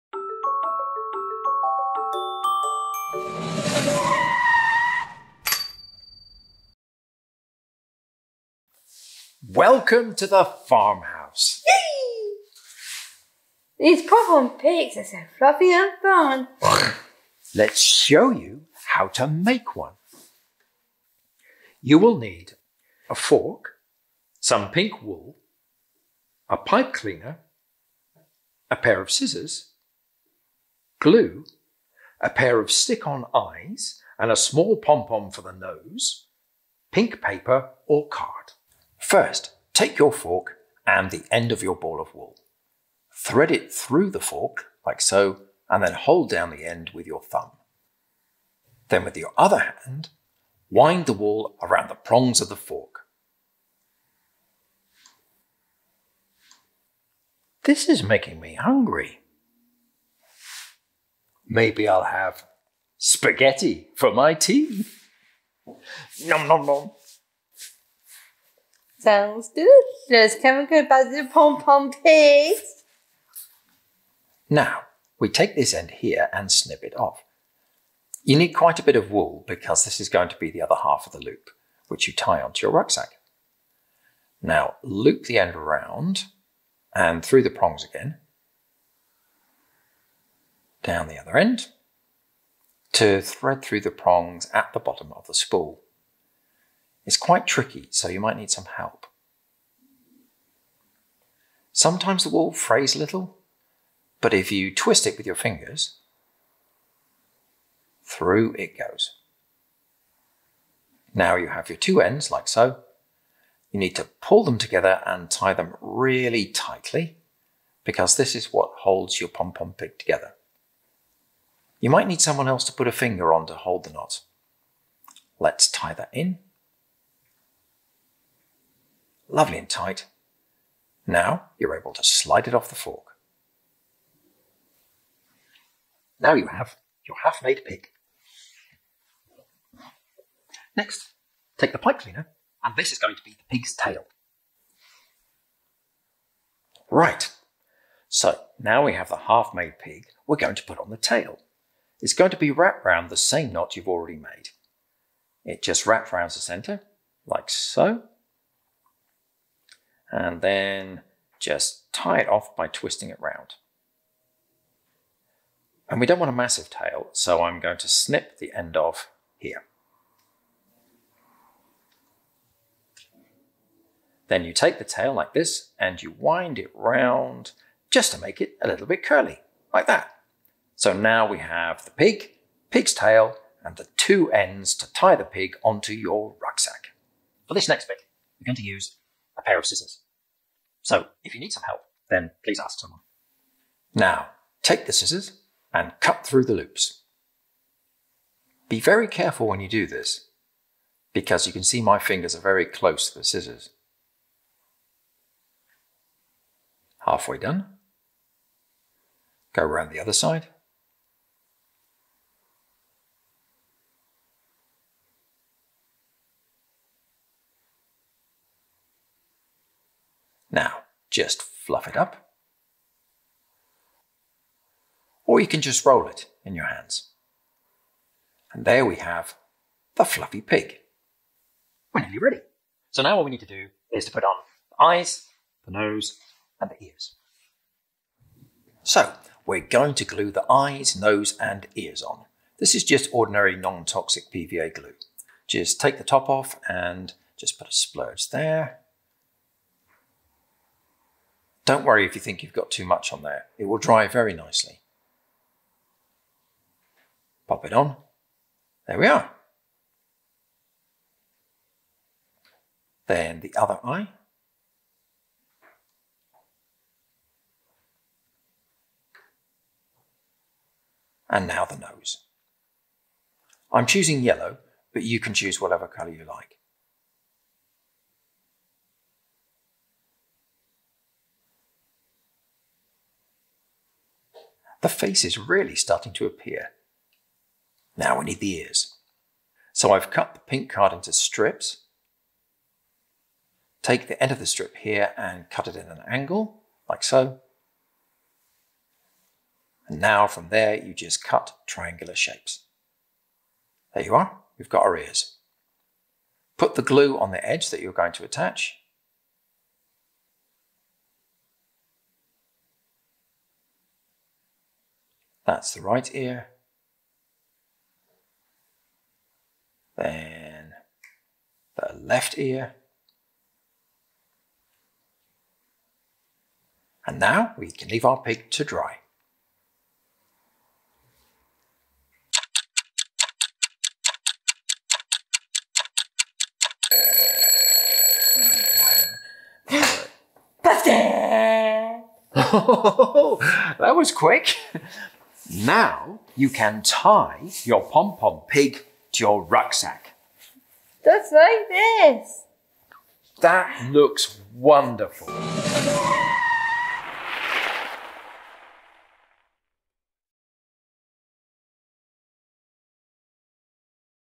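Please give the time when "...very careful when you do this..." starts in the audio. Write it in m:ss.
3:18.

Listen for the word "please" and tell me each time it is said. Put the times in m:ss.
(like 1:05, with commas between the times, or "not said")
3:12.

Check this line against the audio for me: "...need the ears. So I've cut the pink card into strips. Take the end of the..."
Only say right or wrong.
right.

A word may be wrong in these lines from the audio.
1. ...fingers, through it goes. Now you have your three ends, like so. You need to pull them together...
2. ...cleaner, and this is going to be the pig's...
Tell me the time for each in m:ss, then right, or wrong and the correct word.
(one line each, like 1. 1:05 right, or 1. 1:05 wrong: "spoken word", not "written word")
1. 1:45 wrong: "two", not "three"
2. 2:21 right.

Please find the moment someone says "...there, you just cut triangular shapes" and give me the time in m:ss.
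5:00.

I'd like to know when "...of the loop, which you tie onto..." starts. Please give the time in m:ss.
1:21.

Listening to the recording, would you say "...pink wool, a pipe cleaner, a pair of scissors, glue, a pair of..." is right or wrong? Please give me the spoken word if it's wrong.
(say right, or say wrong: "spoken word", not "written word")
right.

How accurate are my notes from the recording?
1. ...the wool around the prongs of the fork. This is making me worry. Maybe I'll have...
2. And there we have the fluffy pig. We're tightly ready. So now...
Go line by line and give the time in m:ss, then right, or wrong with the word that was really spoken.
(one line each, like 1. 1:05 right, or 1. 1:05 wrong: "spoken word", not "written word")
1. 0:51 wrong: "hungry", not "worry"
2. 3:48 wrong: "nearly", not "tightly".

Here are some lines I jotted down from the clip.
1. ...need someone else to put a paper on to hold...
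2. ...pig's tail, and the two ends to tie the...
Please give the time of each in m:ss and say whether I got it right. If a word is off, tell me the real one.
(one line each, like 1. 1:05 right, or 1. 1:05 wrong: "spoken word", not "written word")
1. 2:02 wrong: "finger", not "paper"
2. 3:02 right.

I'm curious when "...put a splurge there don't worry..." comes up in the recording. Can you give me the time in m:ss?
4:07.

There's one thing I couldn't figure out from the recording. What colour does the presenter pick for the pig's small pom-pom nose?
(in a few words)
Yellow.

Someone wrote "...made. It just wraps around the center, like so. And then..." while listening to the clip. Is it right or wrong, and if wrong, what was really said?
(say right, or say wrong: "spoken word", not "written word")
right.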